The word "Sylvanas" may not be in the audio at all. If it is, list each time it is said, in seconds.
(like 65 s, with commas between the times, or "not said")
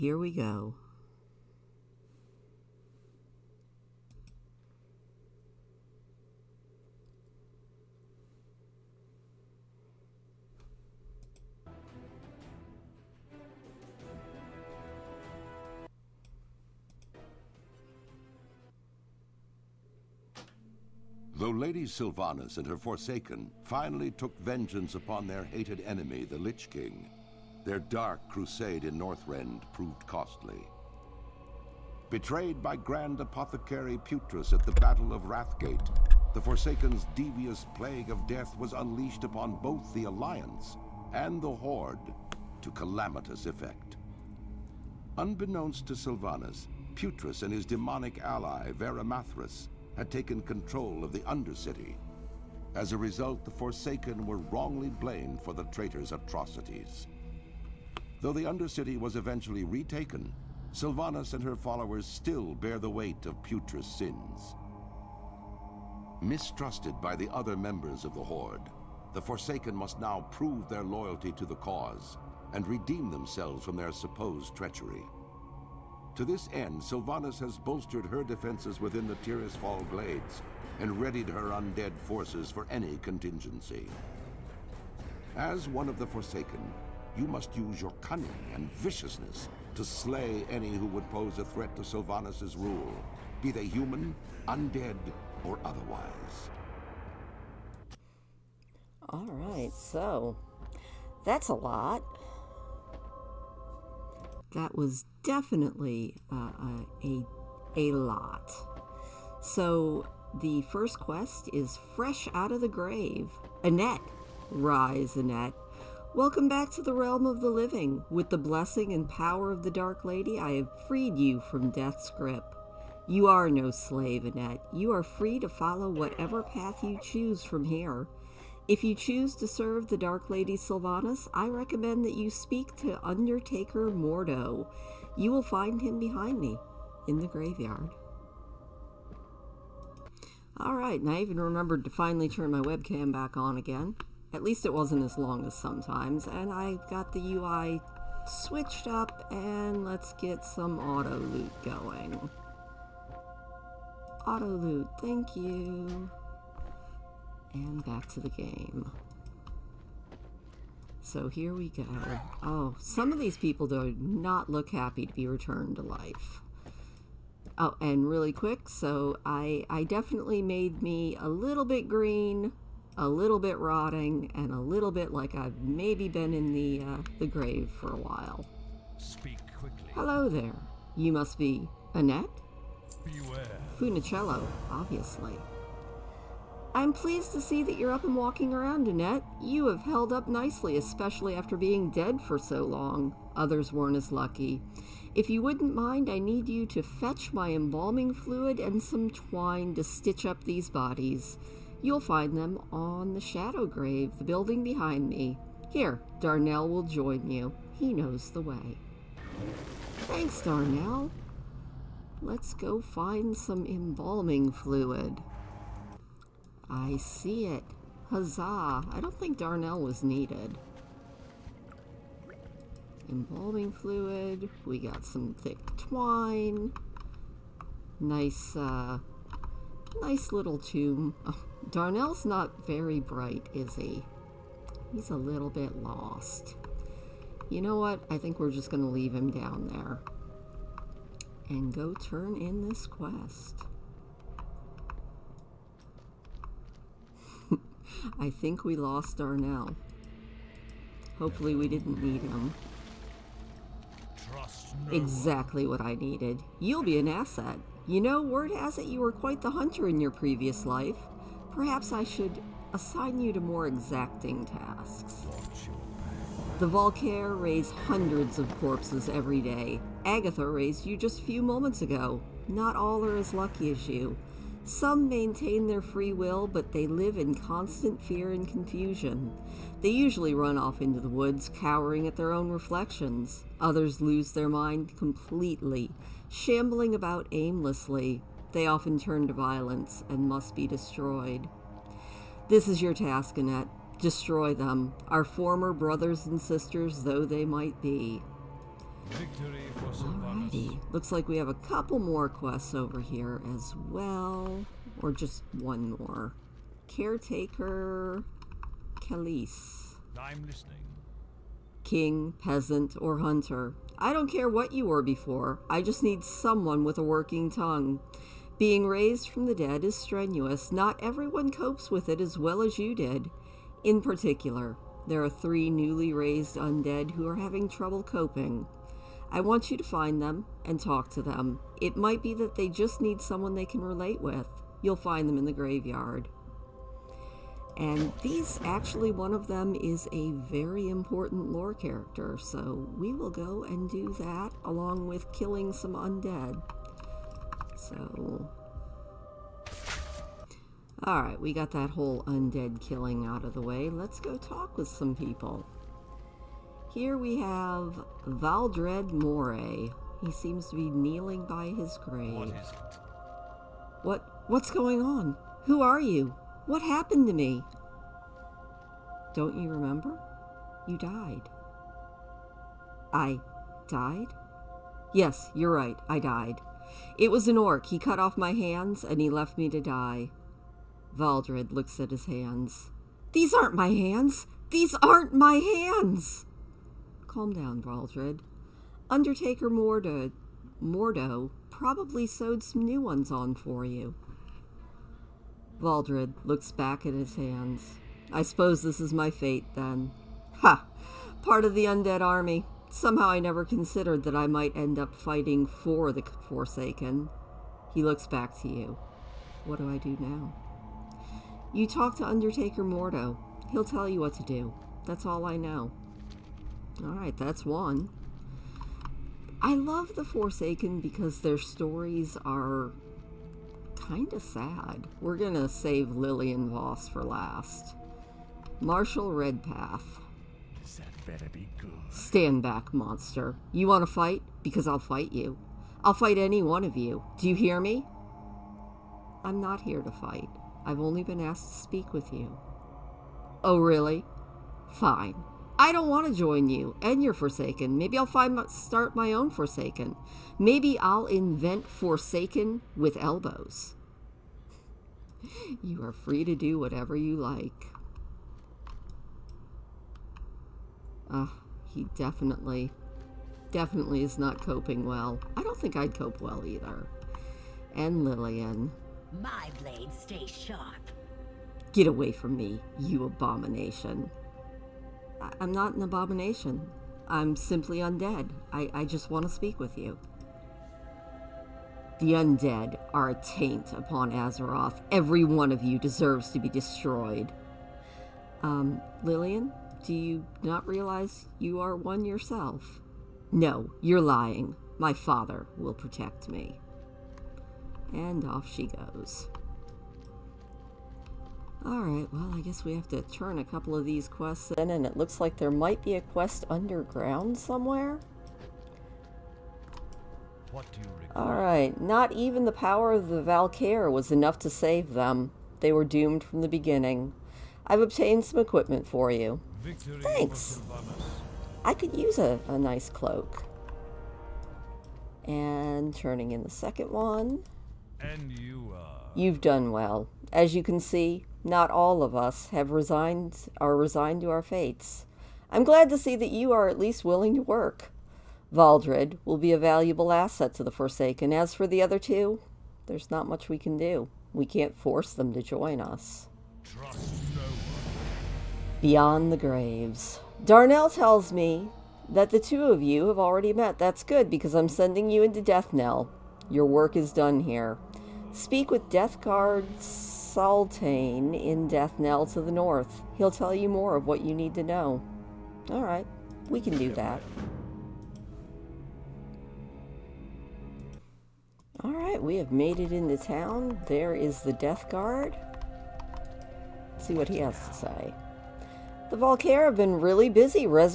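21 s, 45 s, 60 s, 76 s, 91 s, 130 s.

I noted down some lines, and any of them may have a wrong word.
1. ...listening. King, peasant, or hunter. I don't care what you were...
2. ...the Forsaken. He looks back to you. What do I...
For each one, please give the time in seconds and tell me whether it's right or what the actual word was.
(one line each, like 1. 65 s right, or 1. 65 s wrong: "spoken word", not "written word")
1. 310 s right
2. 406 s right.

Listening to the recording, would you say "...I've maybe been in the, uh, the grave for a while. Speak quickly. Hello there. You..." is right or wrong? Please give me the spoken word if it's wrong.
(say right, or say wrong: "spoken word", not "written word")
right.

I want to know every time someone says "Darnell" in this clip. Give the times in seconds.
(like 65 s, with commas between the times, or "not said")
206 s, 210 s, 219 s, 231 s, 249 s, 550 s.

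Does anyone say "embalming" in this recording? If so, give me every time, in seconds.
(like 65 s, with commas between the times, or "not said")
197 s, 213 s, 223 s.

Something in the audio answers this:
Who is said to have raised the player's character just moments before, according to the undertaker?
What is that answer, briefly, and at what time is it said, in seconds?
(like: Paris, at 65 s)
Agatha, at 270 s.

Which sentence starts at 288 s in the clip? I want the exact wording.
They often turn to violence and must be destroyed.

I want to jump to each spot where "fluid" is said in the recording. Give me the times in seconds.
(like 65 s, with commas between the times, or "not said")
198 s, 214 s, 223 s.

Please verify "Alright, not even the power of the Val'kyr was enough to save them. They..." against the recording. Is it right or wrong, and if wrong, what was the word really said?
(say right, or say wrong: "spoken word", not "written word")
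right.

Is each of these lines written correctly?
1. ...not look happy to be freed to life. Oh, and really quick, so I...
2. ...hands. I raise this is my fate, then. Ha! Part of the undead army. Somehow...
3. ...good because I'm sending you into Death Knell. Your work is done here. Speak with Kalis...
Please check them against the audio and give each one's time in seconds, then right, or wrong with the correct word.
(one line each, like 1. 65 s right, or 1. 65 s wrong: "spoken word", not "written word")
1. 163 s wrong: "returned", not "freed"
2. 397 s wrong: "suppose", not "raise"
3. 554 s wrong: "Death", not "Kalis".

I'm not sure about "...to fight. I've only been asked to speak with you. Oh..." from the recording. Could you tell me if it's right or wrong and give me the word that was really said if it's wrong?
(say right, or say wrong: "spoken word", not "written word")
right.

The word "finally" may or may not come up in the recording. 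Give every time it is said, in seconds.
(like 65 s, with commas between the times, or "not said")
23 s, 141 s.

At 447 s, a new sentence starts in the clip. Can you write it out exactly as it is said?
Maybe I'll find my, start my own forsaken.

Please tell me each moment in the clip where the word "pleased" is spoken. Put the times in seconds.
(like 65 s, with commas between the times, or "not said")
186 s.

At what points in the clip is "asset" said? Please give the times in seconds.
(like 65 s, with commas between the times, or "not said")
257 s, 540 s.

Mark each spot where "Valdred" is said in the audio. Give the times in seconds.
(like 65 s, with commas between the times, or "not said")
358 s, 381 s, 387 s, 395 s, 538 s.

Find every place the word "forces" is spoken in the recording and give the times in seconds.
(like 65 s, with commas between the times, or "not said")
82 s, 544 s.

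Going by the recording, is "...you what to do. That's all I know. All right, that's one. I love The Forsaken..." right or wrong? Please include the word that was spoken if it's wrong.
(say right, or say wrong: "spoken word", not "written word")
right.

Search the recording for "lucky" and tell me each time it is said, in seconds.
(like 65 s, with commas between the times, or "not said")
194 s, 273 s.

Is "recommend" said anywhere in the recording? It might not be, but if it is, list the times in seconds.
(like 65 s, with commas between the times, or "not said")
131 s.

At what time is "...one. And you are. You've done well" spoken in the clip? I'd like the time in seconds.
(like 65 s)
527 s.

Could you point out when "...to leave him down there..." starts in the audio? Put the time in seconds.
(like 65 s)
238 s.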